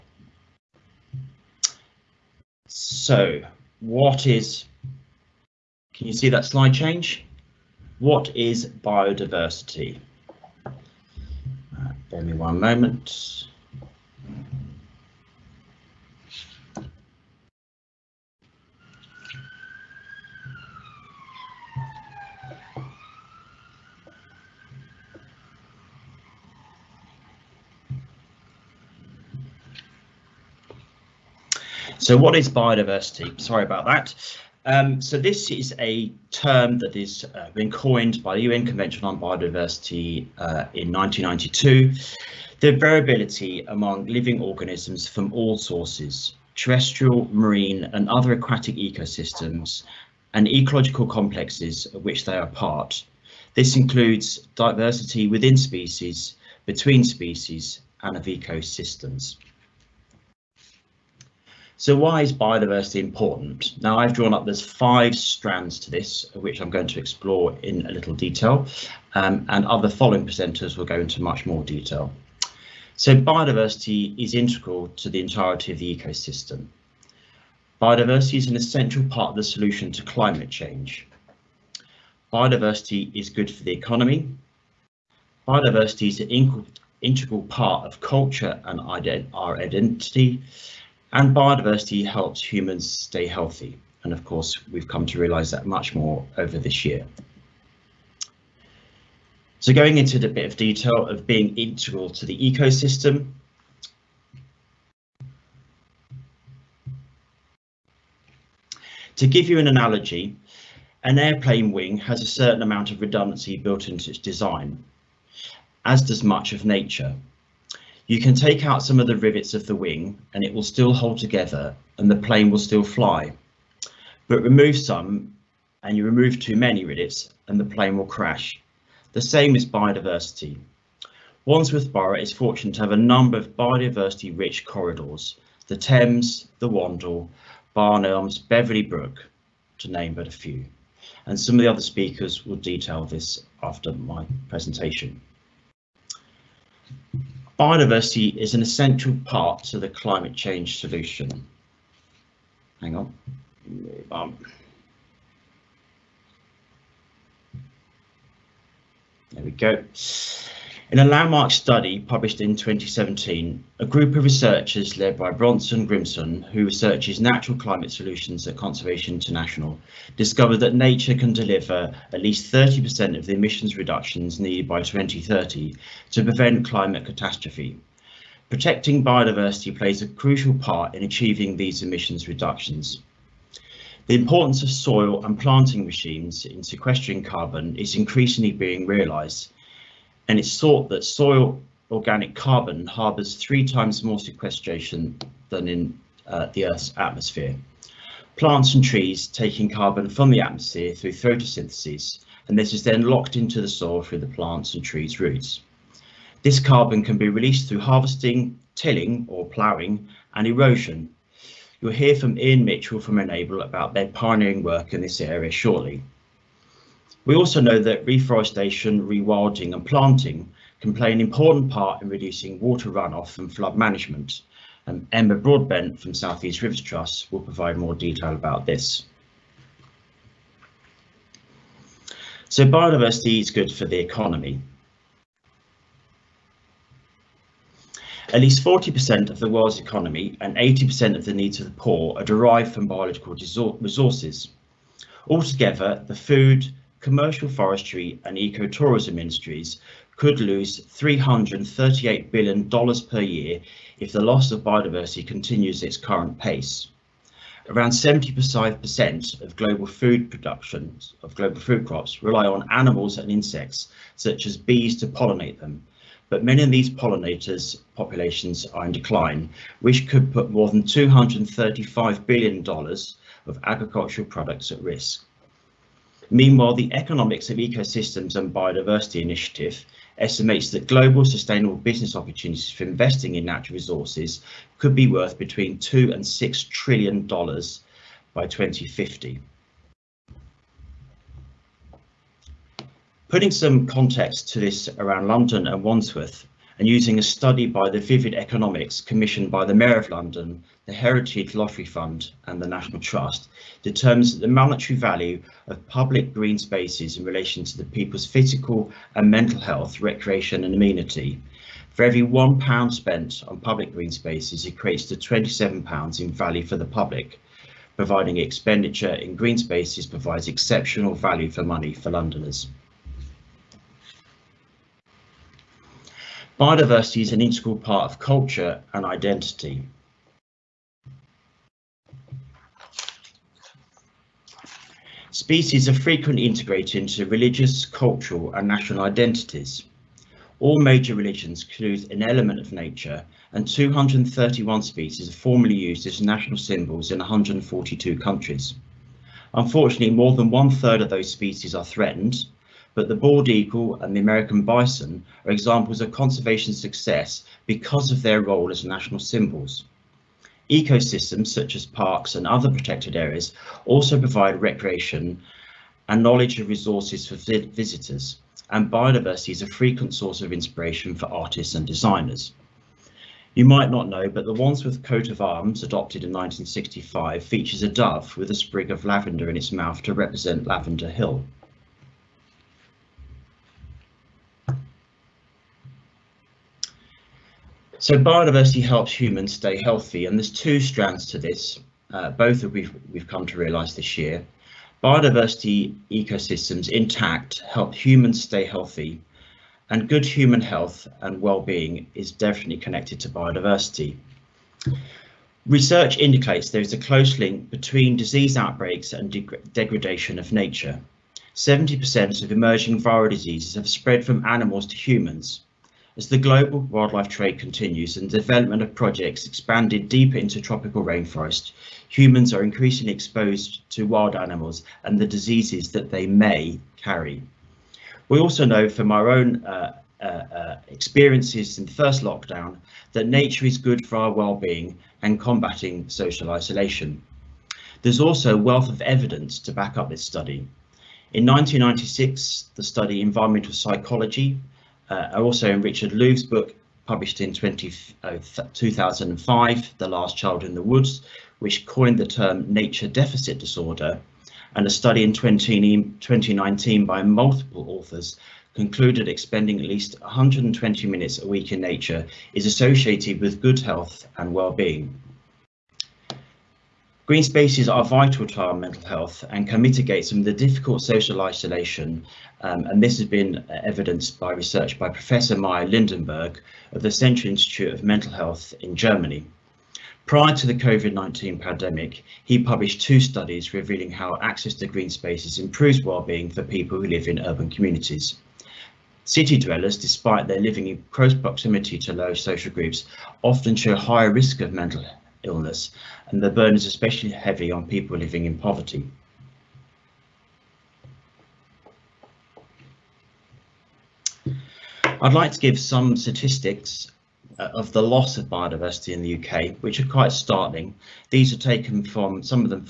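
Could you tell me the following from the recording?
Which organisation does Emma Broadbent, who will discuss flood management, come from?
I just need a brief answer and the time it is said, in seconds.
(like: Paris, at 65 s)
Southeast Rivers Trust, at 226 s.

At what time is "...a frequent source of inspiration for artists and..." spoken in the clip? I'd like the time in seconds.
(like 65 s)
369 s.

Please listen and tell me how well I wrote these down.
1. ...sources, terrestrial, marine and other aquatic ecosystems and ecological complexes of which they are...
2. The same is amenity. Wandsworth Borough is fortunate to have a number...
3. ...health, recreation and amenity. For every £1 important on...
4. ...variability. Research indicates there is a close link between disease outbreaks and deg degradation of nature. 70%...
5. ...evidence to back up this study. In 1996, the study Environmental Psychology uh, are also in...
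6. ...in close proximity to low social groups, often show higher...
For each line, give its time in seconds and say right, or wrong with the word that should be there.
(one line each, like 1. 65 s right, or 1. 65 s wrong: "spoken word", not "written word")
1. 45 s right
2. 129 s wrong: "biodiversity", not "amenity"
3. 309 s wrong: "spent", not "important"
4. 403 s wrong: "biodiversity", not "variability"
5. 439 s right
6. 490 s right.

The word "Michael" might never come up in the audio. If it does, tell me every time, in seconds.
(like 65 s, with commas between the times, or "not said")
not said.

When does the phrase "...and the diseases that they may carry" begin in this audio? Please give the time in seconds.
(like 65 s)
425 s.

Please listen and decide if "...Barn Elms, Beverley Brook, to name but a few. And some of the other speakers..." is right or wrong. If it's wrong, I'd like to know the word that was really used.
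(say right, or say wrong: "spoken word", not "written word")
right.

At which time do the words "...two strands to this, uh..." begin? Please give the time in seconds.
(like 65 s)
390 s.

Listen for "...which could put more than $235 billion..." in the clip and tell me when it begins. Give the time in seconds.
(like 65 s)
269 s.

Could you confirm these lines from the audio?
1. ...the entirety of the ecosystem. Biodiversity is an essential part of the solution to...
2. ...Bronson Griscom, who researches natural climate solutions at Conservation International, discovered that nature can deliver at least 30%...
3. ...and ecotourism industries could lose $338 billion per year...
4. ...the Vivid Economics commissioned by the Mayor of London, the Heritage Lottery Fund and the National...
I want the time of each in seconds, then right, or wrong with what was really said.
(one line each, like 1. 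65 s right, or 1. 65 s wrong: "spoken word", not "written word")
1. 75 s right
2. 165 s right
3. 248 s right
4. 297 s right.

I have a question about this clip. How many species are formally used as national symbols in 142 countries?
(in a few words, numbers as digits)
231.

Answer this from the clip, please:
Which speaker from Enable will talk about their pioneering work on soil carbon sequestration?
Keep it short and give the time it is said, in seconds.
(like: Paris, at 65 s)
Ian Mitchell, at 212 s.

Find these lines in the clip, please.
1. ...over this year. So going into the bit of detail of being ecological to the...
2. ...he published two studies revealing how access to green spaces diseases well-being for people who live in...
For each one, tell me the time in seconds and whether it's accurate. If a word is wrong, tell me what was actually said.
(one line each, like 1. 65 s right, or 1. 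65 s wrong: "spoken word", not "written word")
1. 96 s wrong: "integral", not "ecological"
2. 482 s wrong: "improves", not "diseases".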